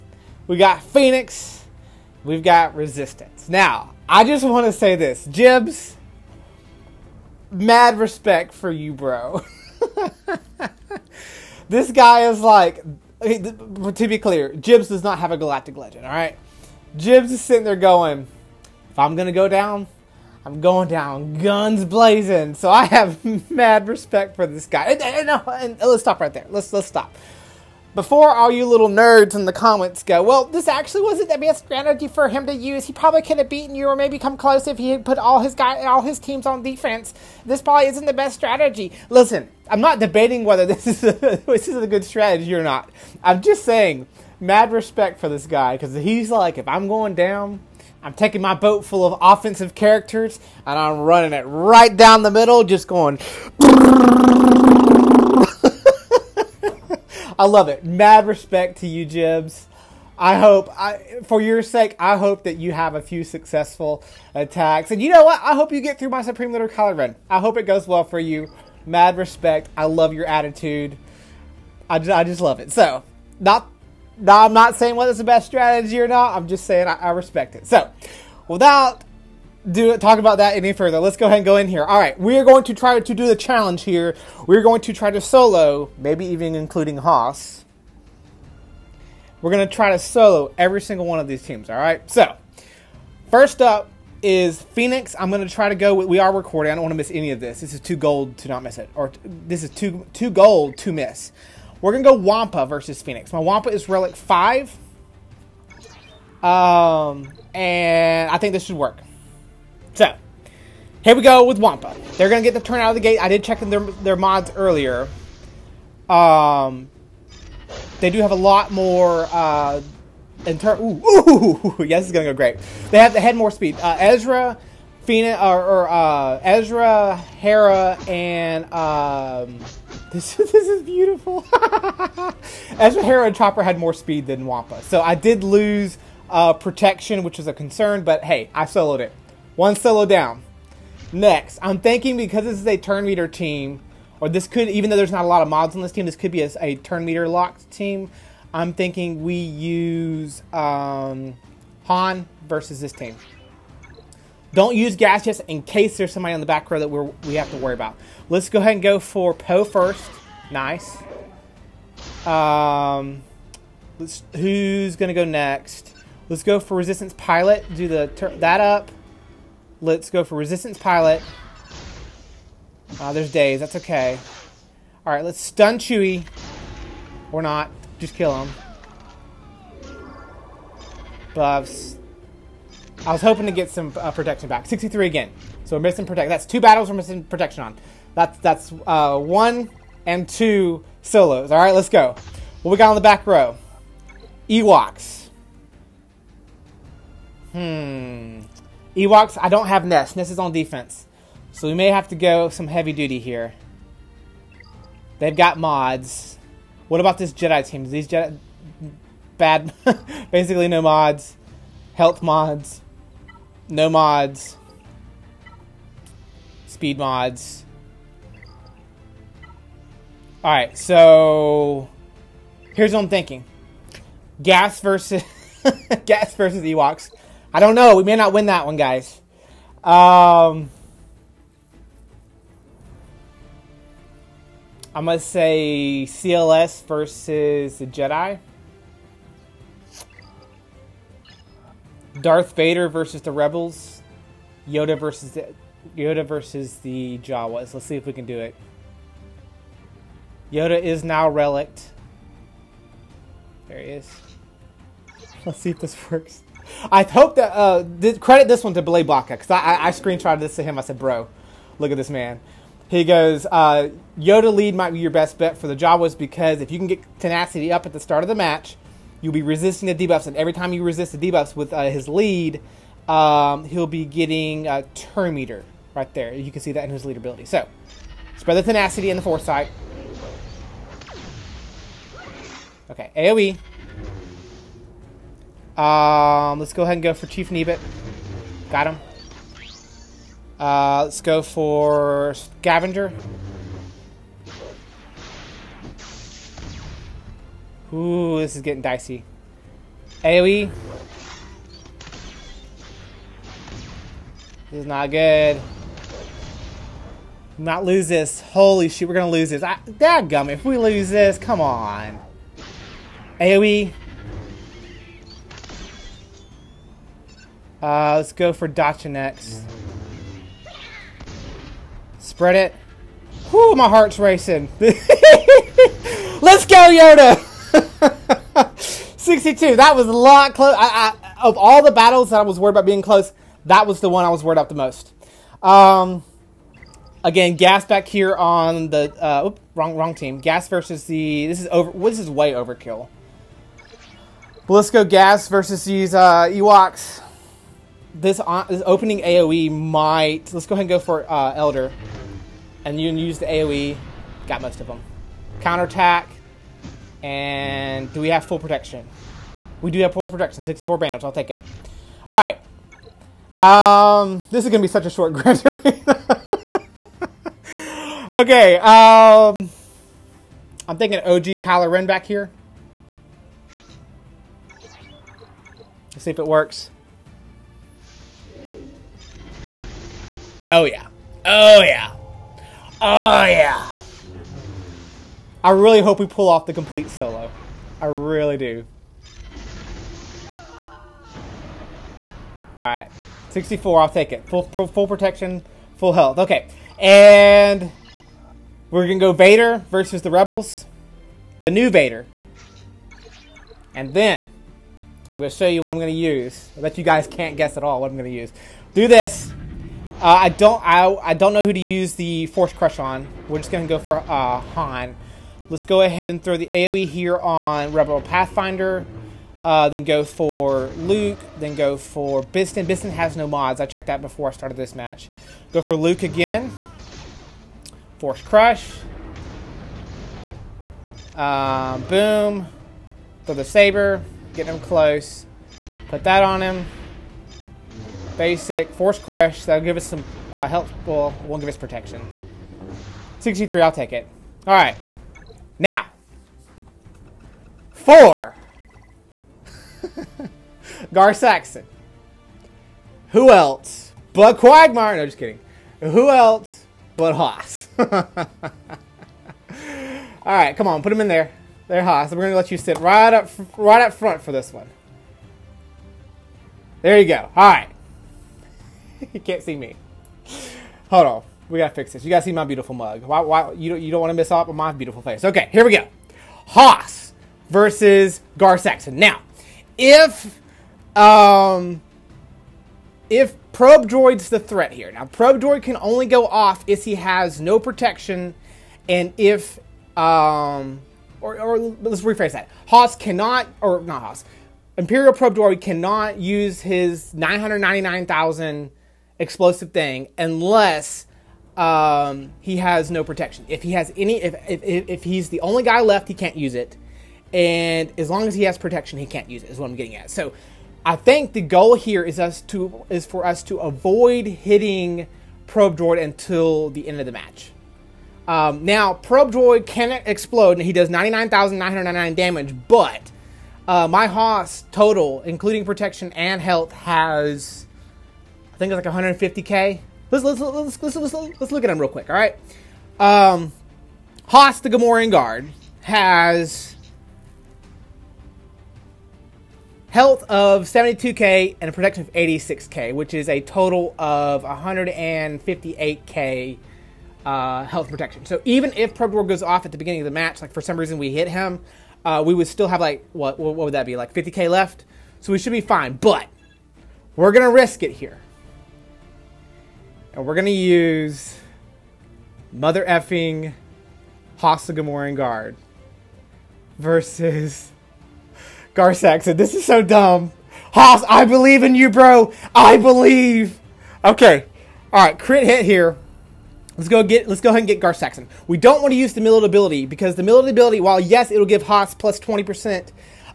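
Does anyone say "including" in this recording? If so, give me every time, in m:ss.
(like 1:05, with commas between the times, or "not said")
1:26, 8:45.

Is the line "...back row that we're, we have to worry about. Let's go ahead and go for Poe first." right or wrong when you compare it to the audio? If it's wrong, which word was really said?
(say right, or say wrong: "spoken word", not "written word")
right.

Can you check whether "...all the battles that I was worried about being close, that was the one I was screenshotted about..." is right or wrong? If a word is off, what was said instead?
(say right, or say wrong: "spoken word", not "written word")
wrong: "worried", not "screenshotted".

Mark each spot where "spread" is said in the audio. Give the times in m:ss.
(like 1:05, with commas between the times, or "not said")
4:38, 5:22.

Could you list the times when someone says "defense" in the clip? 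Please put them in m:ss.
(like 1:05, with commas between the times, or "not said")
0:36, 3:20.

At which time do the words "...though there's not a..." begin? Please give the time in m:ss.
2:24.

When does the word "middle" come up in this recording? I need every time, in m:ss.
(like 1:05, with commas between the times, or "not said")
0:52.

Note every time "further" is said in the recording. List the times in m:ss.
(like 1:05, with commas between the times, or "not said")
1:20.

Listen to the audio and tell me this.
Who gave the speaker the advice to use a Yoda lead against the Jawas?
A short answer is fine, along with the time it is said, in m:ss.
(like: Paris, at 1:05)
Blay Blocker, at 4:18.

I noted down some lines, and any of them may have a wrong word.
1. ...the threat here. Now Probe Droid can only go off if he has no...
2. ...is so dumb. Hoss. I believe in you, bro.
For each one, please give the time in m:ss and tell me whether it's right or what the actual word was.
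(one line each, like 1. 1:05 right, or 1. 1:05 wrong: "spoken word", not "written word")
1. 8:04 right
2. 9:29 right.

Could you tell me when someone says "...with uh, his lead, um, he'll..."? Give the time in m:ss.
4:31.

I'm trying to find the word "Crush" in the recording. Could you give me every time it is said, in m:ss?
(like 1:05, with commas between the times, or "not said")
6:52, 7:08, 7:19.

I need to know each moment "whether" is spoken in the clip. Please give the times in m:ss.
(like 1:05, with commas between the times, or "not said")
0:40, 1:14.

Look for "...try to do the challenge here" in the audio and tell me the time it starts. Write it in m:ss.
1:22.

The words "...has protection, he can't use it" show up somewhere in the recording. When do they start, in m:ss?
8:28.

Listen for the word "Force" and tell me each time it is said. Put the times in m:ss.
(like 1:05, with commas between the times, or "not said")
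6:52, 7:08, 7:18.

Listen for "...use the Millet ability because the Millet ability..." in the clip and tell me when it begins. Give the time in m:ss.
9:39.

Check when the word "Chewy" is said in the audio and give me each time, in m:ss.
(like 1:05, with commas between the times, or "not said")
2:55.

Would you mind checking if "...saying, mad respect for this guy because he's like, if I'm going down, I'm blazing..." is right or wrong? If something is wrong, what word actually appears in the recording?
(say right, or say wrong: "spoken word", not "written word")
wrong: "taking", not "blazing".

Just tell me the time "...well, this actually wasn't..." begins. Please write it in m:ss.
0:30.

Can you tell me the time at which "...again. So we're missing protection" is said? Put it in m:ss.
3:05.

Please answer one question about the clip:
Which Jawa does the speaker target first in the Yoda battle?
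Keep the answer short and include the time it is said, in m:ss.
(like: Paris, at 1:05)
Chief Nebit, at 4:47.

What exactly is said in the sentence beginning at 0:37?
This probably isn't the best strategy.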